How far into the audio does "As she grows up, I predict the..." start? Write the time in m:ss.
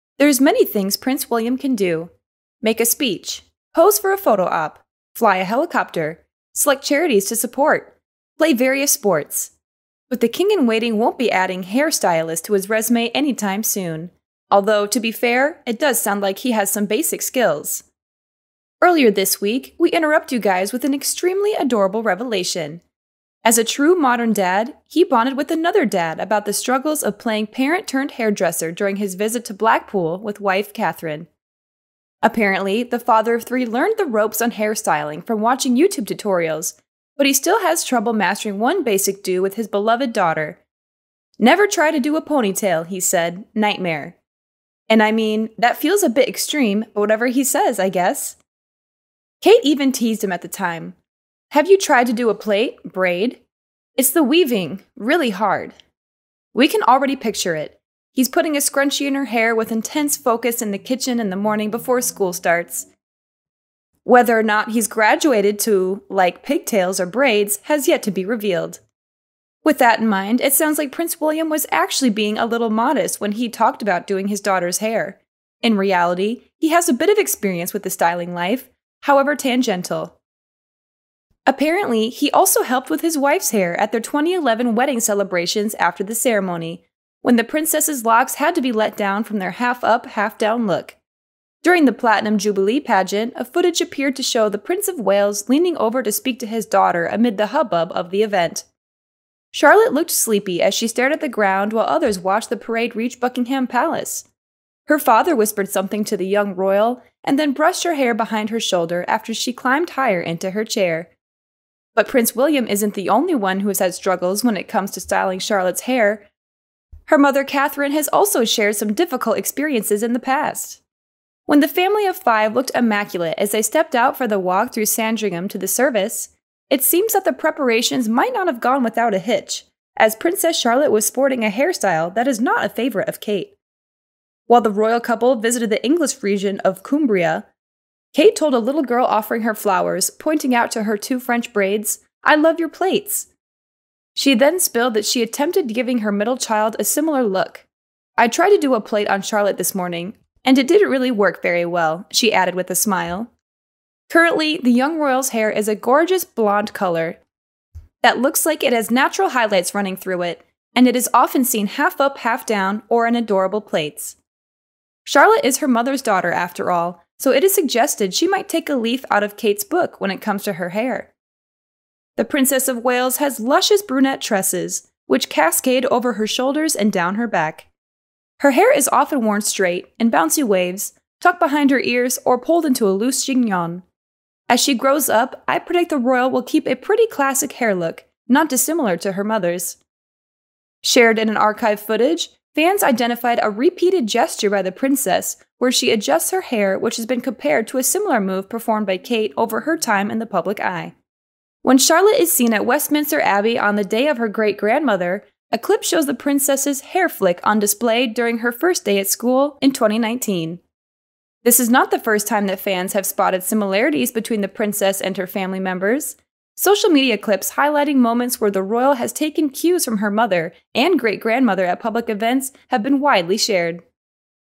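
3:04.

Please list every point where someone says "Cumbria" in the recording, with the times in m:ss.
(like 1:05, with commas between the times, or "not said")
2:16.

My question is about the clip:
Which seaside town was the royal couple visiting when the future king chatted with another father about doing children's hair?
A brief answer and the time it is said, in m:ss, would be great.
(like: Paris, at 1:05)
Blackpool, at 0:29.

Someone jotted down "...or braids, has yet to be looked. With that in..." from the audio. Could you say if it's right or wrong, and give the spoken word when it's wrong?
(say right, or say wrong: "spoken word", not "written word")
wrong: "revealed", not "looked".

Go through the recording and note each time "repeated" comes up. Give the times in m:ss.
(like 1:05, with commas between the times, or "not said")
3:13.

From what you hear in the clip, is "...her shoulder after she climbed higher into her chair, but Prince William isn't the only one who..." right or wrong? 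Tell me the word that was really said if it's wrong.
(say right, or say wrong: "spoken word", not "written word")
right.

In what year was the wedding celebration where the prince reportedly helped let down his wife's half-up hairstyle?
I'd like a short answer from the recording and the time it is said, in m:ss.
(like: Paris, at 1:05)
2011, at 1:24.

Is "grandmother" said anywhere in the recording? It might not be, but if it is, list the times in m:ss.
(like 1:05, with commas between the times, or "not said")
3:24, 3:41.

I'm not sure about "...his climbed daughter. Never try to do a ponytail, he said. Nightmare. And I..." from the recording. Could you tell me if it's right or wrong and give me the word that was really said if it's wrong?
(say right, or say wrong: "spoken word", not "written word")
wrong: "beloved", not "climbed".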